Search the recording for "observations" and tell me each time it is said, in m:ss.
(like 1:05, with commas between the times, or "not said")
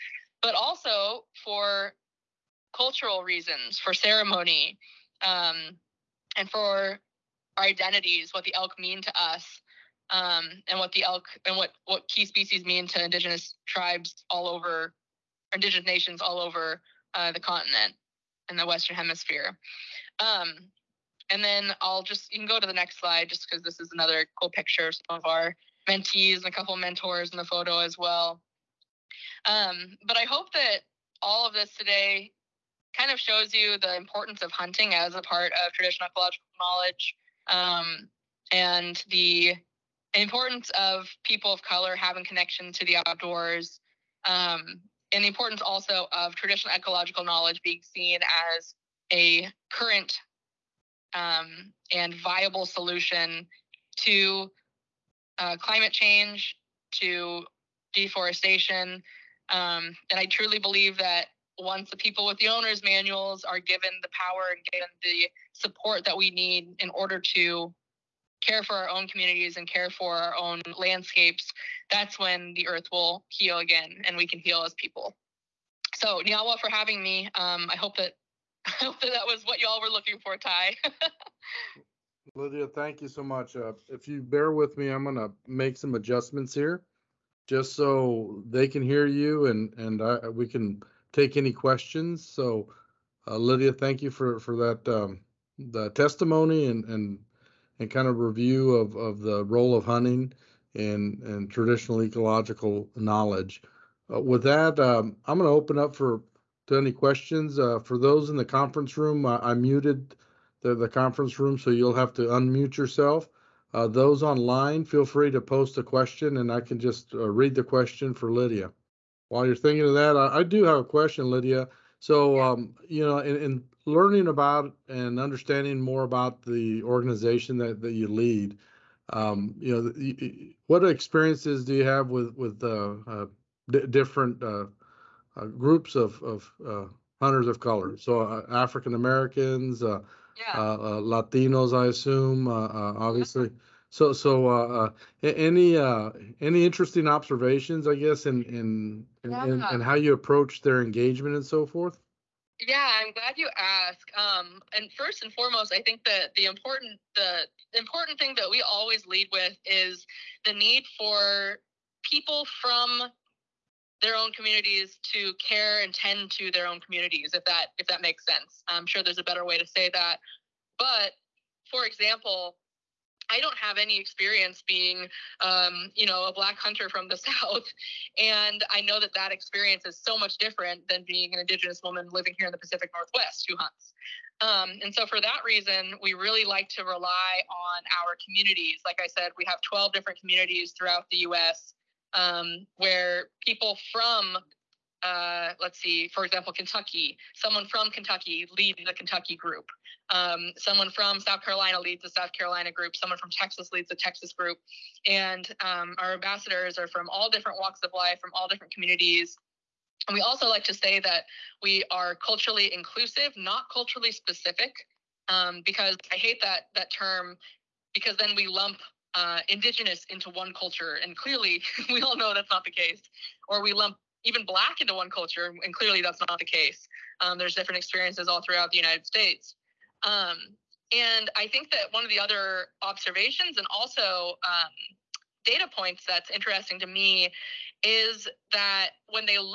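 2:27, 3:52.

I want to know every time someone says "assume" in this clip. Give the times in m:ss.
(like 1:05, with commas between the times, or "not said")
2:21.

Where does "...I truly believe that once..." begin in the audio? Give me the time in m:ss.
1:00.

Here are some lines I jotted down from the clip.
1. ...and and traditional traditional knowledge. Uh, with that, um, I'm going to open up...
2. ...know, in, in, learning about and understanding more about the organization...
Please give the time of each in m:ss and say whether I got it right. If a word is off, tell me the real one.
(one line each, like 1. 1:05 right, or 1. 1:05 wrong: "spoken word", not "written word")
1. 1:40 wrong: "ecological", not "traditional"
2. 2:03 right.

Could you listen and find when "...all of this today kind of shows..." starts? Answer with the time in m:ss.
0:31.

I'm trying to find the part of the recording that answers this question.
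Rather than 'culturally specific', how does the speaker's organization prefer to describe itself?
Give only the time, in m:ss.
3:32.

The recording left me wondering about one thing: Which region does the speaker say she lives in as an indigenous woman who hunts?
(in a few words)
Pacific Northwest.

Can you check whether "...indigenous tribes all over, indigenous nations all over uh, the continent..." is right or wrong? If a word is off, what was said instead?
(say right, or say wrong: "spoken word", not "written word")
right.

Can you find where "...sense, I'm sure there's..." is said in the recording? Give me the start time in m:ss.
2:48.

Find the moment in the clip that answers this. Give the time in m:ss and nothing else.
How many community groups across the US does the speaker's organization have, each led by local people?
3:09.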